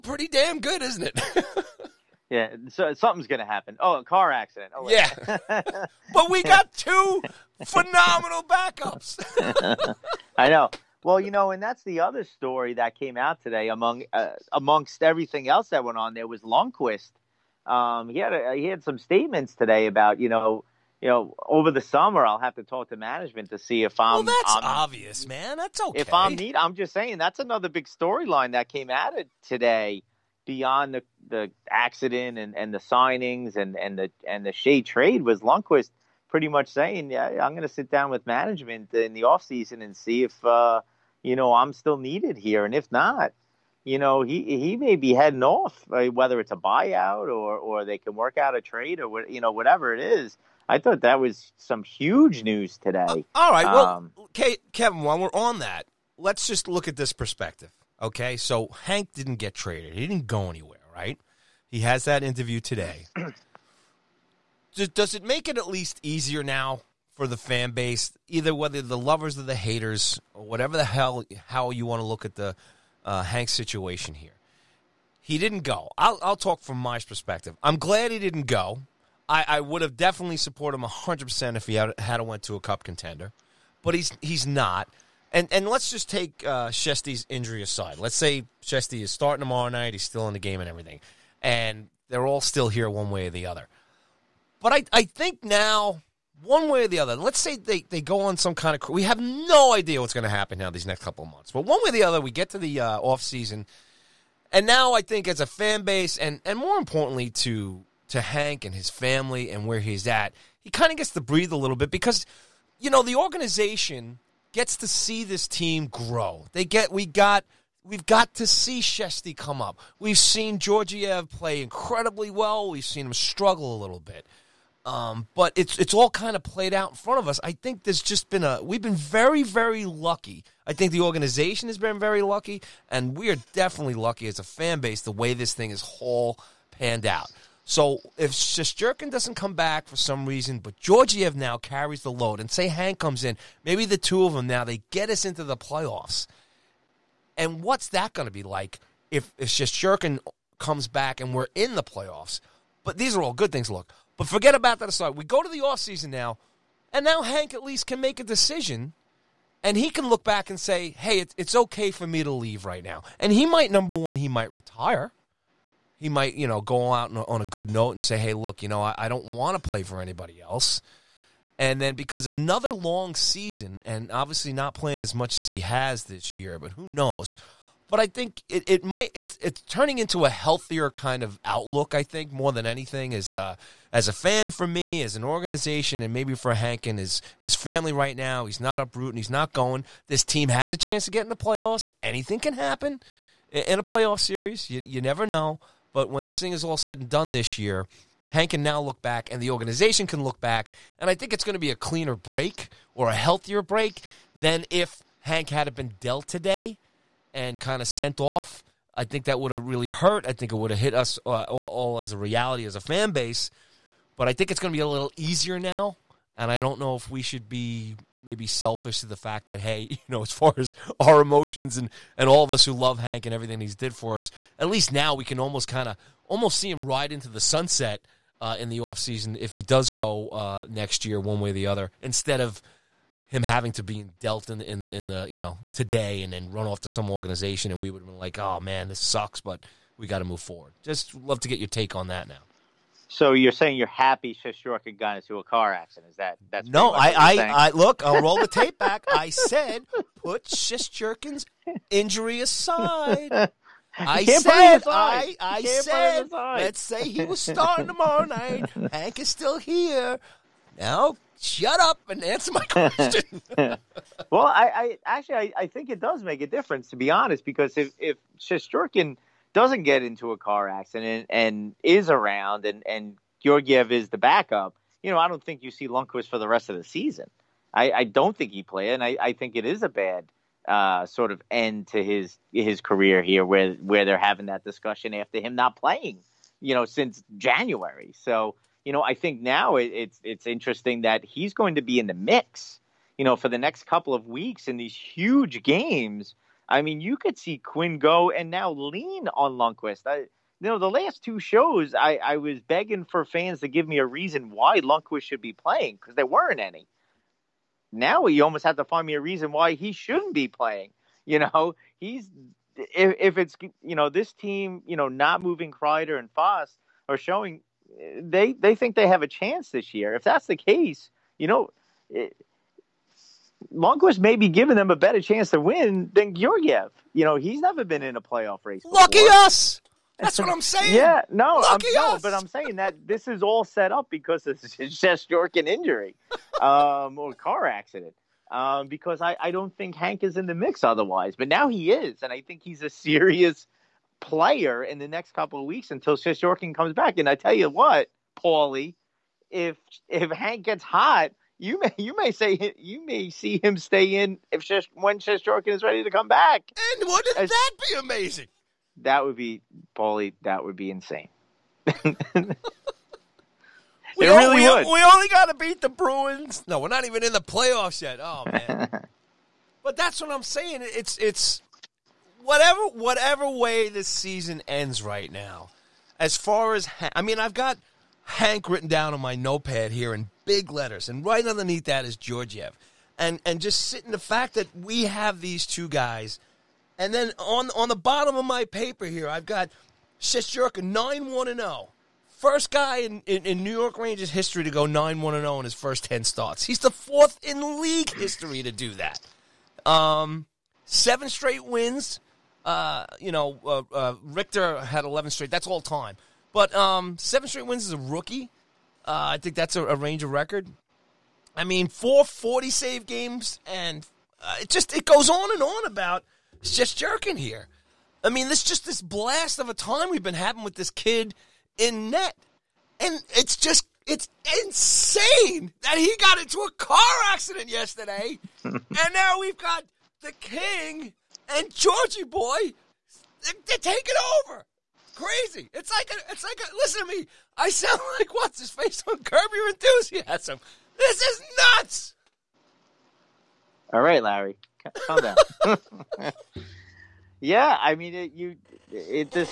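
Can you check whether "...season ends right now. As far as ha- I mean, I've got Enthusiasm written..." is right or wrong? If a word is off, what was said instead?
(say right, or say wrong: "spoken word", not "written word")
wrong: "Hank", not "Enthusiasm".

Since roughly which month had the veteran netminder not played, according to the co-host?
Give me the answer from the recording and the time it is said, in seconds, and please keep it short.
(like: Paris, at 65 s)
January, at 287 s.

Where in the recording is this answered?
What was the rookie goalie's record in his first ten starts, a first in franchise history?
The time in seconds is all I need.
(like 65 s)
394 s.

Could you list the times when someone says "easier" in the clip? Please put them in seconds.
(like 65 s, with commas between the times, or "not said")
66 s, 215 s.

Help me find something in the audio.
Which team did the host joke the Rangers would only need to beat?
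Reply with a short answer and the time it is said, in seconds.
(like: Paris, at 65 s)
the Bruins, at 365 s.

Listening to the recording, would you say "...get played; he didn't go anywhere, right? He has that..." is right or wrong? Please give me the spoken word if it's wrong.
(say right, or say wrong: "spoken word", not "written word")
wrong: "traded", not "played".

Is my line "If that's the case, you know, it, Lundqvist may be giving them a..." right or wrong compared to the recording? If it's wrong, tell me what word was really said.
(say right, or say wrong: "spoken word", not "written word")
right.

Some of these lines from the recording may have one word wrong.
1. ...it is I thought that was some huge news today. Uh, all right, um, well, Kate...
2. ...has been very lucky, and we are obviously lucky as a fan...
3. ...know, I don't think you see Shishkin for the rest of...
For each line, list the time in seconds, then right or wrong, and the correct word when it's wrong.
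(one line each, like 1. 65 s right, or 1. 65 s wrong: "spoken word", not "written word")
1. 49 s right
2. 131 s wrong: "definitely", not "obviously"
3. 275 s wrong: "Lundqvist", not "Shishkin".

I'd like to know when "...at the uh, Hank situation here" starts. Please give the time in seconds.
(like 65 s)
72 s.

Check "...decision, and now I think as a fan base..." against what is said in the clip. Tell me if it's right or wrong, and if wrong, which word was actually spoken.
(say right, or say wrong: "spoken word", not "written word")
wrong: "season", not "decision".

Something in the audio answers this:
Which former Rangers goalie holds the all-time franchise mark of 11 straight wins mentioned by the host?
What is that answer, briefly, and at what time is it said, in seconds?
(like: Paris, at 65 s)
Richter, at 404 s.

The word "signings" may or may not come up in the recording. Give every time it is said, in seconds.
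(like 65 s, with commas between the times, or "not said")
32 s.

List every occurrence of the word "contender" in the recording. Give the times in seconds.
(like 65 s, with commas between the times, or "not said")
82 s.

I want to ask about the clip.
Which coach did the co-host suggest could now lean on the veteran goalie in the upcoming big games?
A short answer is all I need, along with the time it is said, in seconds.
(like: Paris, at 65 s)
Quinn, at 297 s.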